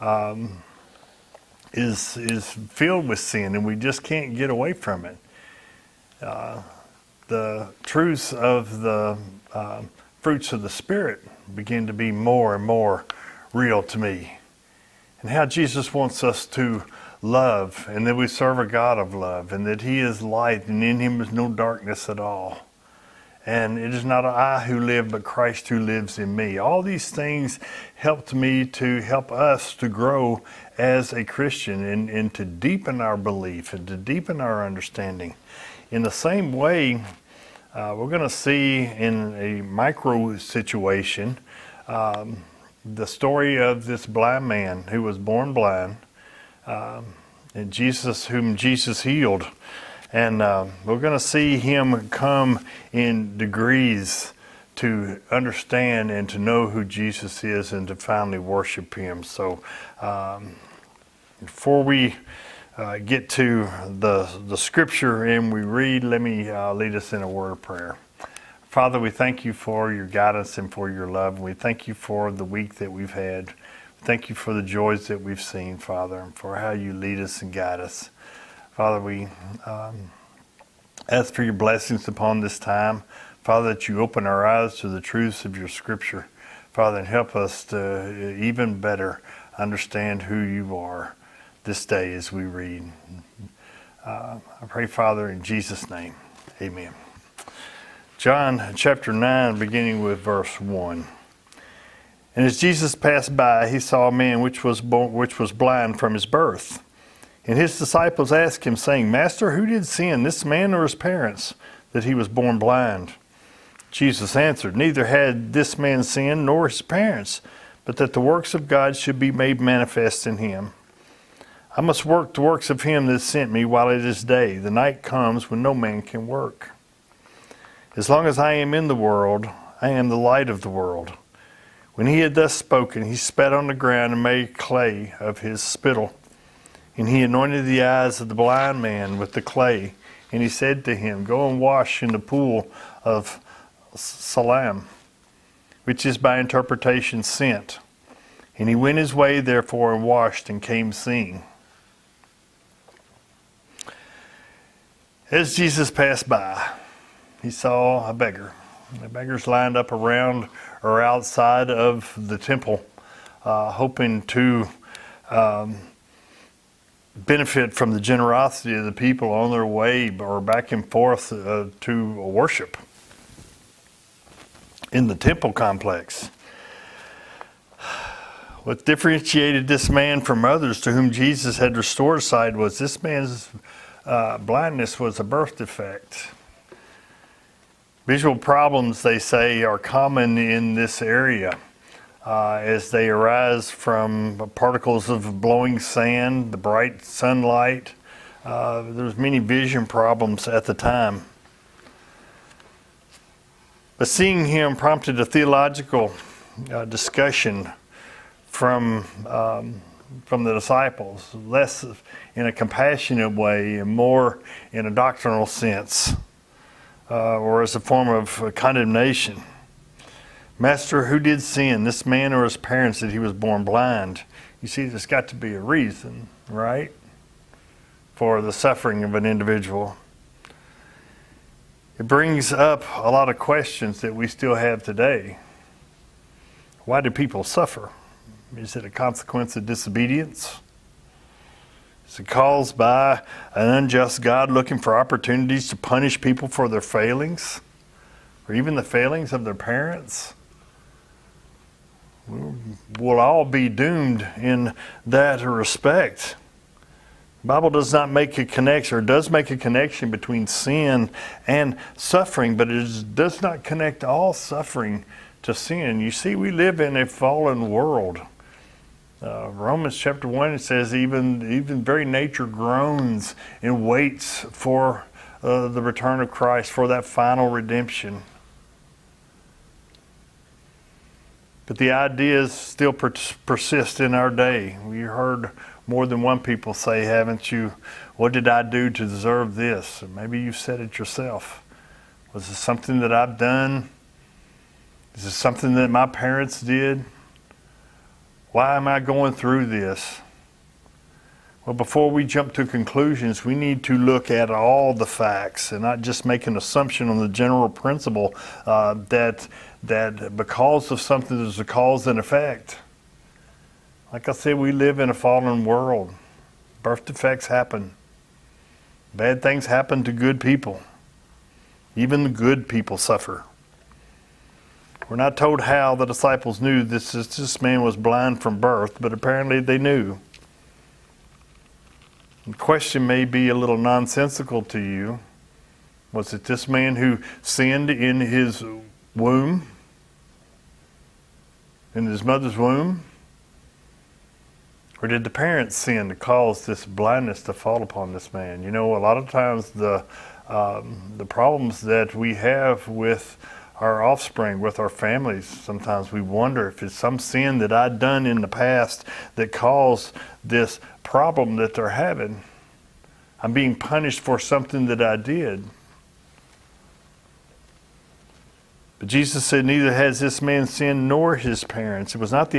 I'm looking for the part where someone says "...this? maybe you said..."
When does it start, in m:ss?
4:49.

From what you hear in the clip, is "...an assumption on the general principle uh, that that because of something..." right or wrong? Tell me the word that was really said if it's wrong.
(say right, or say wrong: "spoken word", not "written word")
right.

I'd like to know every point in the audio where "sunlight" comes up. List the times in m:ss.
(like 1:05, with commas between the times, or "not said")
3:17.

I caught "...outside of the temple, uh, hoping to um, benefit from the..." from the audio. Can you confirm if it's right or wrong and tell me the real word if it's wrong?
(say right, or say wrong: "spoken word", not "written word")
right.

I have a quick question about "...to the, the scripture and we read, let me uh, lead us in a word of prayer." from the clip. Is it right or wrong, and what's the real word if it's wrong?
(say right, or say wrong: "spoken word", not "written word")
right.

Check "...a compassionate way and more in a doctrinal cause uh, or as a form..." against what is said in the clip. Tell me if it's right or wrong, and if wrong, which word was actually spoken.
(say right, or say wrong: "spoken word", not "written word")
wrong: "sense", not "cause".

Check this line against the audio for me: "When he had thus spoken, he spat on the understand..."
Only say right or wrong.
wrong.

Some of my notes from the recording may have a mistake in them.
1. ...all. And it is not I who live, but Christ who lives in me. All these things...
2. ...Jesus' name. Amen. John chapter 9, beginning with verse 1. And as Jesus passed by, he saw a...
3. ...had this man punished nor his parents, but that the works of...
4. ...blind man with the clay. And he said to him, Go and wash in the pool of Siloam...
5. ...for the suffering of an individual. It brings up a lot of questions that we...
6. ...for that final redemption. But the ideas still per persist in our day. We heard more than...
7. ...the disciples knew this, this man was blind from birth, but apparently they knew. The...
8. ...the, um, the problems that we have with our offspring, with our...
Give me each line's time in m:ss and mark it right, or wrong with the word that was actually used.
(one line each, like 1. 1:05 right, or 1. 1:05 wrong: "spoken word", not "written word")
1. 0:22 right
2. 1:35 right
3. 1:55 wrong: "sinned", not "punished"
4. 2:18 right
5. 3:48 right
6. 4:36 right
7. 5:25 right
8. 5:49 right.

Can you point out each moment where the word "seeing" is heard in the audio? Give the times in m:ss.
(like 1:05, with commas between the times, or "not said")
2:30, 3:24.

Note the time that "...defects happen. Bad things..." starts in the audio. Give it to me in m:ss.
5:17.